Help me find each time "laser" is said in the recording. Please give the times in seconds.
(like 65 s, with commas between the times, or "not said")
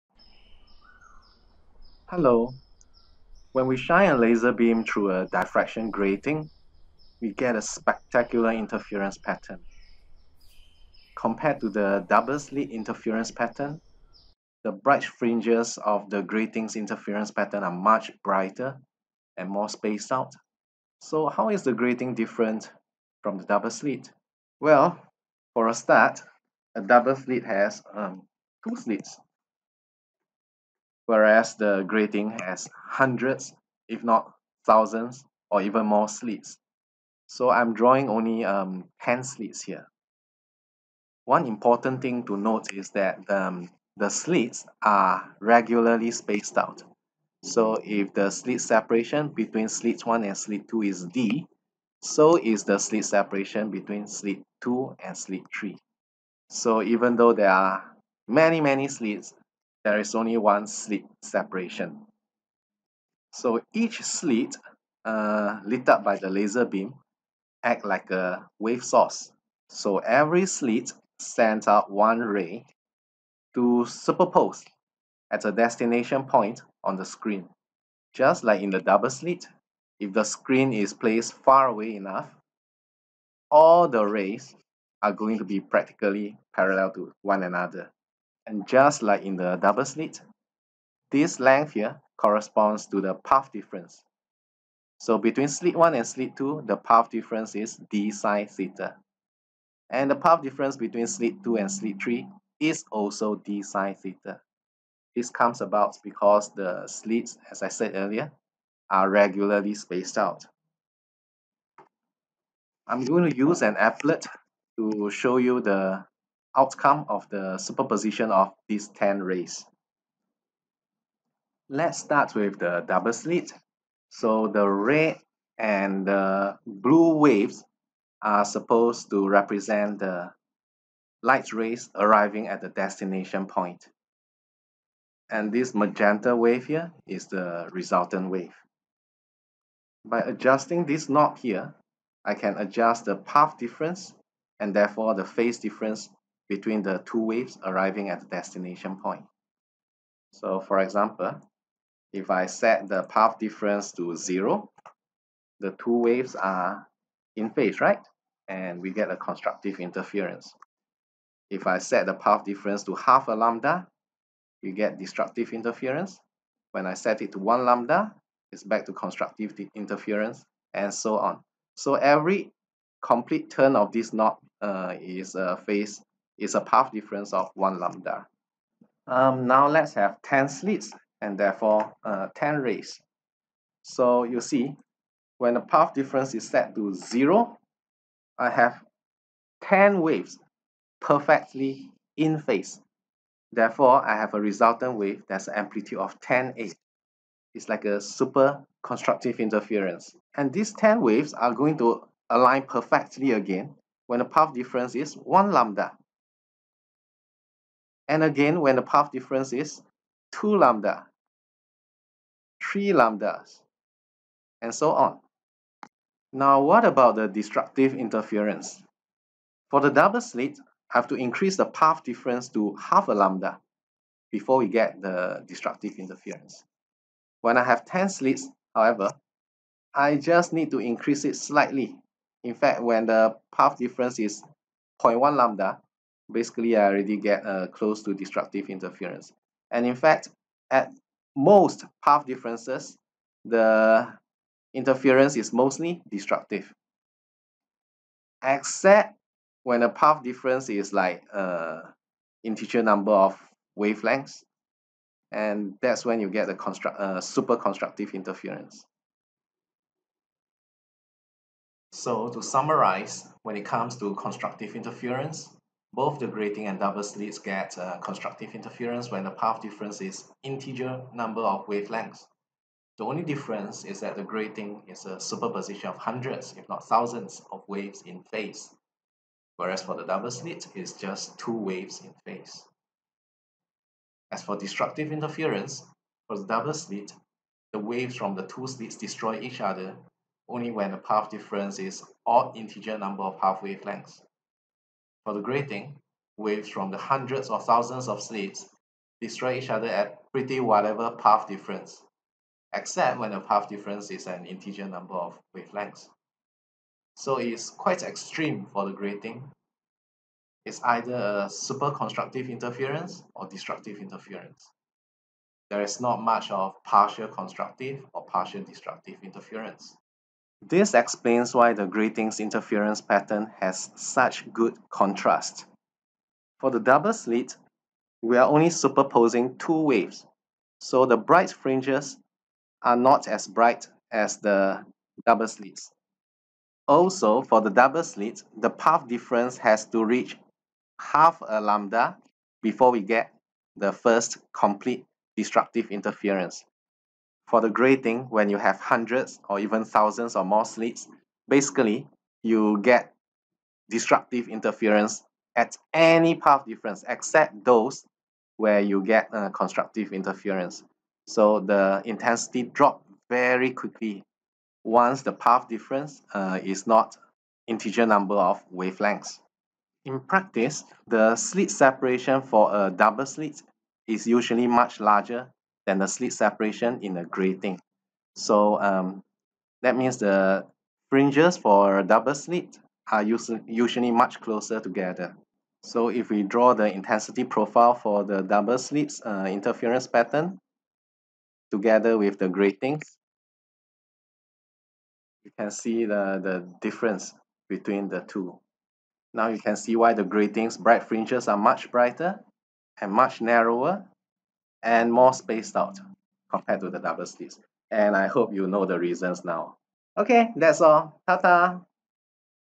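4 s, 66 s.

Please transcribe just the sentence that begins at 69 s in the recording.
So every slit sends out one ray to superpose at a destination point on the screen.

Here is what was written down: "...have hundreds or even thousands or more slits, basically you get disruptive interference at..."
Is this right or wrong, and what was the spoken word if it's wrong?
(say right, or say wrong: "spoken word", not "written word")
right.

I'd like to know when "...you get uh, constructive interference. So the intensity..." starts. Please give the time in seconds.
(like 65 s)
358 s.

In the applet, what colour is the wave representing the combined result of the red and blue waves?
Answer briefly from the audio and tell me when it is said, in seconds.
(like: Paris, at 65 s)
magenta, at 135 s.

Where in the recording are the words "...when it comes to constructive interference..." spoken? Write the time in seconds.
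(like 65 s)
263 s.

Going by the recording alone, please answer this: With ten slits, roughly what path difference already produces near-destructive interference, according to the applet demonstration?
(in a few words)
0.1 lambda.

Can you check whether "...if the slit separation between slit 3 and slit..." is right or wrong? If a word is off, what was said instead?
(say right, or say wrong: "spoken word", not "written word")
wrong: "1", not "3".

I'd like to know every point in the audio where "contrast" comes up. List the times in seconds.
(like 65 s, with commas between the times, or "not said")
324 s.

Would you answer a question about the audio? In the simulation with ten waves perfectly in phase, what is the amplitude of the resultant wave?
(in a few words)
10A.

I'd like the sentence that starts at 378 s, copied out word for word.
So um, that means the fringes for double slit are usually much closer together.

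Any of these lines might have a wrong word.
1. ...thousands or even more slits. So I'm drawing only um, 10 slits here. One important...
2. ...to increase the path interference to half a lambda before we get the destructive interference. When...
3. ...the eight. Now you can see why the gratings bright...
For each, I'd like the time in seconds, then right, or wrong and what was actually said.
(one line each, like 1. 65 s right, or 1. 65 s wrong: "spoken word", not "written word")
1. 34 s right
2. 221 s wrong: "difference", not "interference"
3. 398 s wrong: "two", not "eight".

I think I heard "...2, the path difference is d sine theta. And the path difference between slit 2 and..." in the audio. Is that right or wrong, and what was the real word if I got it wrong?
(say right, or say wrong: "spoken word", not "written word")
right.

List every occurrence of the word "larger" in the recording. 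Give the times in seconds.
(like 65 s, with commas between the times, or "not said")
375 s.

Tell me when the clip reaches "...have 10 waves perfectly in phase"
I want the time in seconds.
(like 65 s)
188 s.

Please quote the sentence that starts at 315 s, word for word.
There is not much of partial constructive or partial destructive interference.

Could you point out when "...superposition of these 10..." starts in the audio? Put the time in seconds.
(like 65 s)
117 s.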